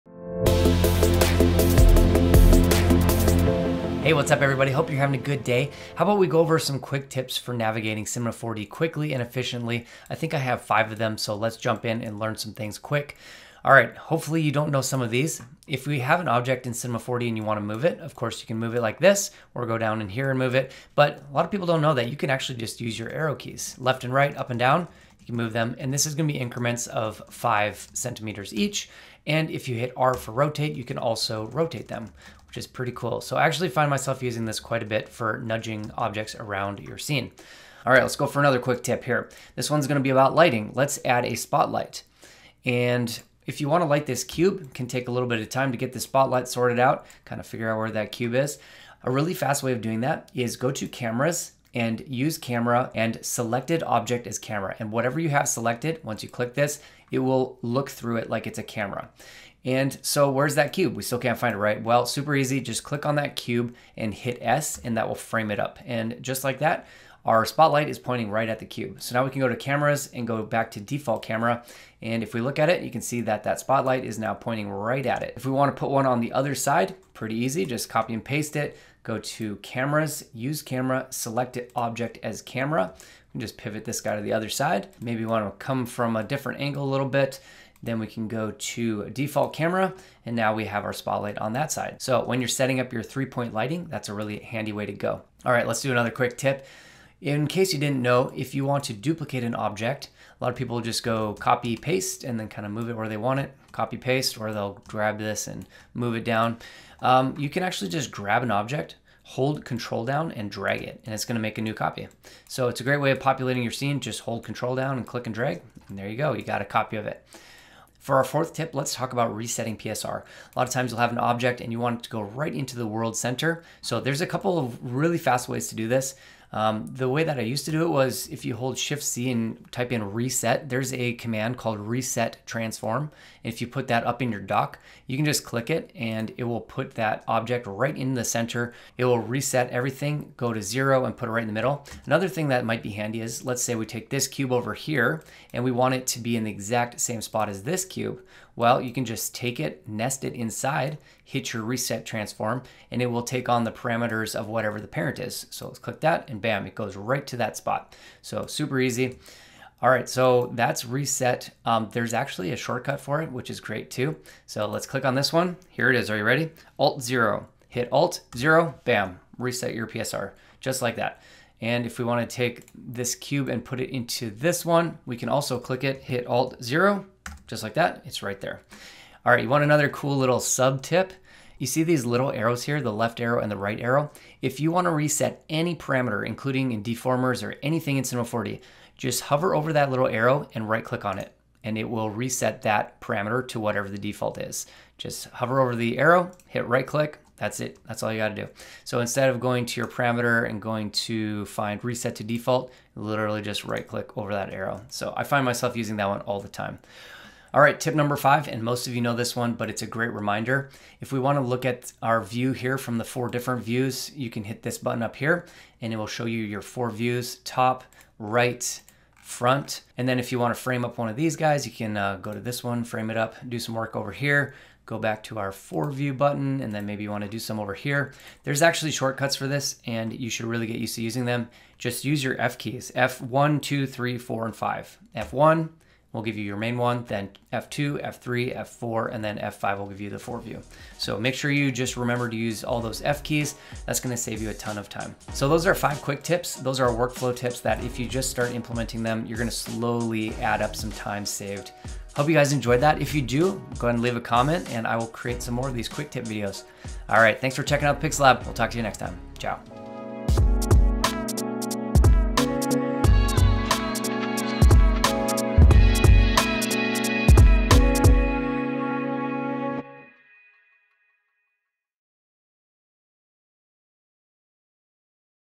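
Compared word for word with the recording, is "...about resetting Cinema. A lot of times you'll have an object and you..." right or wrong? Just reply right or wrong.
wrong.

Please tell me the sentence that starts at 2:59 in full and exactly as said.
All right, you want another cool little sub tip?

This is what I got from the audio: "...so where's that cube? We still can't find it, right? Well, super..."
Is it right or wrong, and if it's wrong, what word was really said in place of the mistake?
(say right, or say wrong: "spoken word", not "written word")
right.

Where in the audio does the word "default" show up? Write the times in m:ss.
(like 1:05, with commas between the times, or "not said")
1:10, 1:29, 3:13, 3:22.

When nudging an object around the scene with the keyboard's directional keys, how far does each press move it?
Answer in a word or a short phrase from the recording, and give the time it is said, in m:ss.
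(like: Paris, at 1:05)
5 centimeters, at 0:27.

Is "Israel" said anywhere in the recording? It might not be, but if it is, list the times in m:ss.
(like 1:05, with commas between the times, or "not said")
not said.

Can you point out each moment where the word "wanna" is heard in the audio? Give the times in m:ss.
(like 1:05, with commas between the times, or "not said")
0:17, 0:43, 1:15, 2:52.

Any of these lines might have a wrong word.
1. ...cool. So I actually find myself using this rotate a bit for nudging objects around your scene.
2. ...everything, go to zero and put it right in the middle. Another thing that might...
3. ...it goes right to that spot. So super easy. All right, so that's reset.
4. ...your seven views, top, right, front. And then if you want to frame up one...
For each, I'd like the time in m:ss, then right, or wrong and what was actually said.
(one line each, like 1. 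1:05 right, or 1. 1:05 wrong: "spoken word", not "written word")
1. 0:32 wrong: "quite", not "rotate"
2. 2:19 right
3. 2:36 right
4. 3:36 wrong: "four", not "seven".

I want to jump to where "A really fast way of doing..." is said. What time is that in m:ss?
0:49.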